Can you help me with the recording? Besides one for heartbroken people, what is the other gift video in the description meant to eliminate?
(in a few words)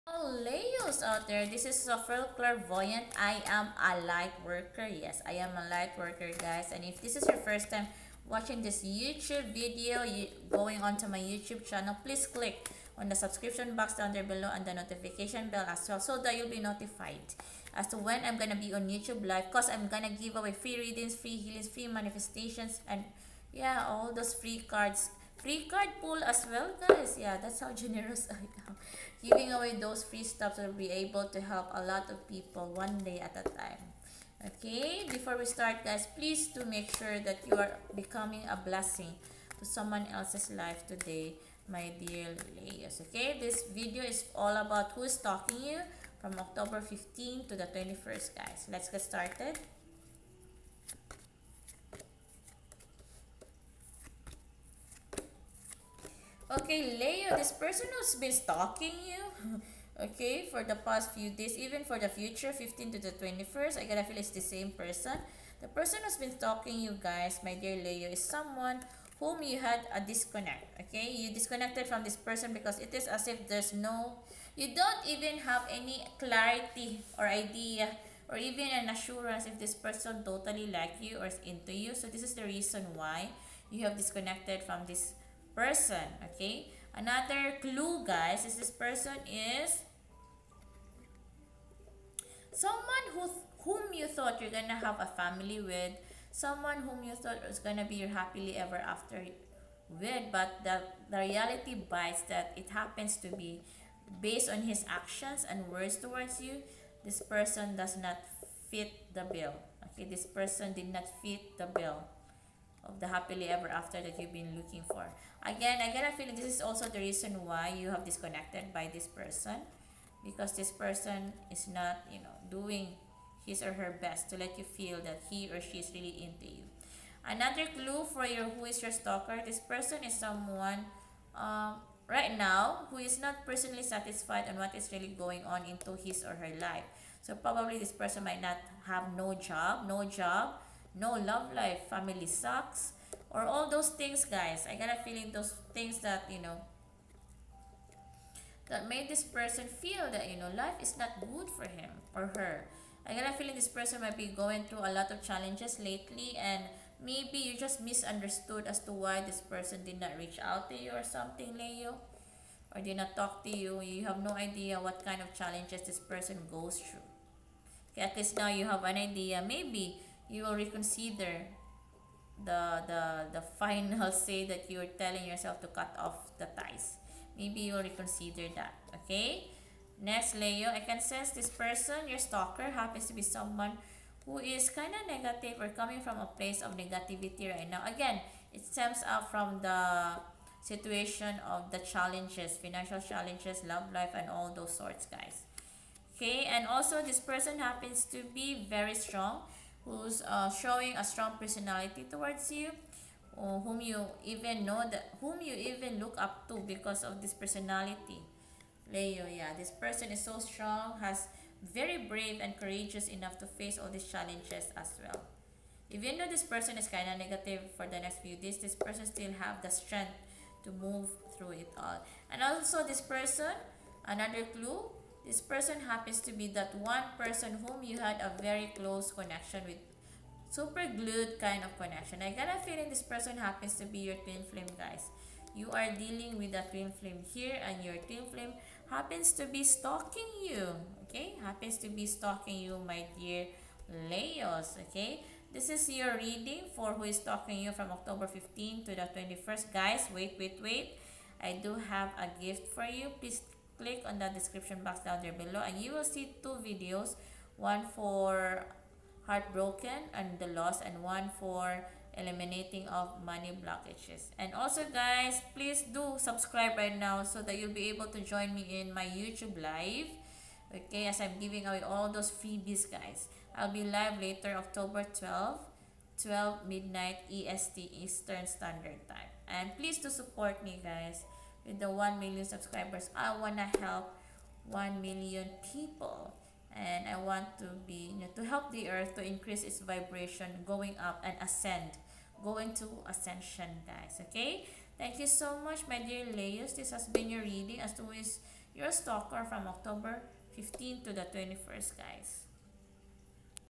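Money blockages.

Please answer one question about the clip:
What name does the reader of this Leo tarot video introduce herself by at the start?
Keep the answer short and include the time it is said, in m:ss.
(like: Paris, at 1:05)
Sopheriel Clairvoyant, at 0:01.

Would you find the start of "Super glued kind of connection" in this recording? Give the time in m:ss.
3:50.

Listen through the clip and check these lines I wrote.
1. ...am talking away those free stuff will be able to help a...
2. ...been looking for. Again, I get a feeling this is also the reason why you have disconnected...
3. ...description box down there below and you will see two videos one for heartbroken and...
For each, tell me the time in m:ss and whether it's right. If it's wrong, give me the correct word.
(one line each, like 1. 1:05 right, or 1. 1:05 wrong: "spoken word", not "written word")
1. 0:28 wrong: "giving", not "talking"
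2. 1:54 right
3. 4:14 right.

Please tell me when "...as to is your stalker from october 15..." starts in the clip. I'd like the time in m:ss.
4:57.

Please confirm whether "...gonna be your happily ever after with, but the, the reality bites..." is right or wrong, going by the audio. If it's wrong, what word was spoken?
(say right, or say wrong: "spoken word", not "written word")
right.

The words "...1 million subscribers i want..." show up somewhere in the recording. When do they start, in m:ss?
4:41.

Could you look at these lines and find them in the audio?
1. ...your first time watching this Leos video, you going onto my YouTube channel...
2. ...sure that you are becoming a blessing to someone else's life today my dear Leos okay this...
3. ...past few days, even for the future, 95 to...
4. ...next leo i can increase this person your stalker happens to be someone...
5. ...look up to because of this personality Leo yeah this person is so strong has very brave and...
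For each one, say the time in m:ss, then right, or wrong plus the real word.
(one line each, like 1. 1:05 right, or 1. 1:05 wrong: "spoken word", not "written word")
1. 0:07 wrong: "YouTube", not "Leos"
2. 0:36 right
3. 1:00 wrong: "15", not "95"
4. 3:00 wrong: "sense", not "increase"
5. 3:25 right.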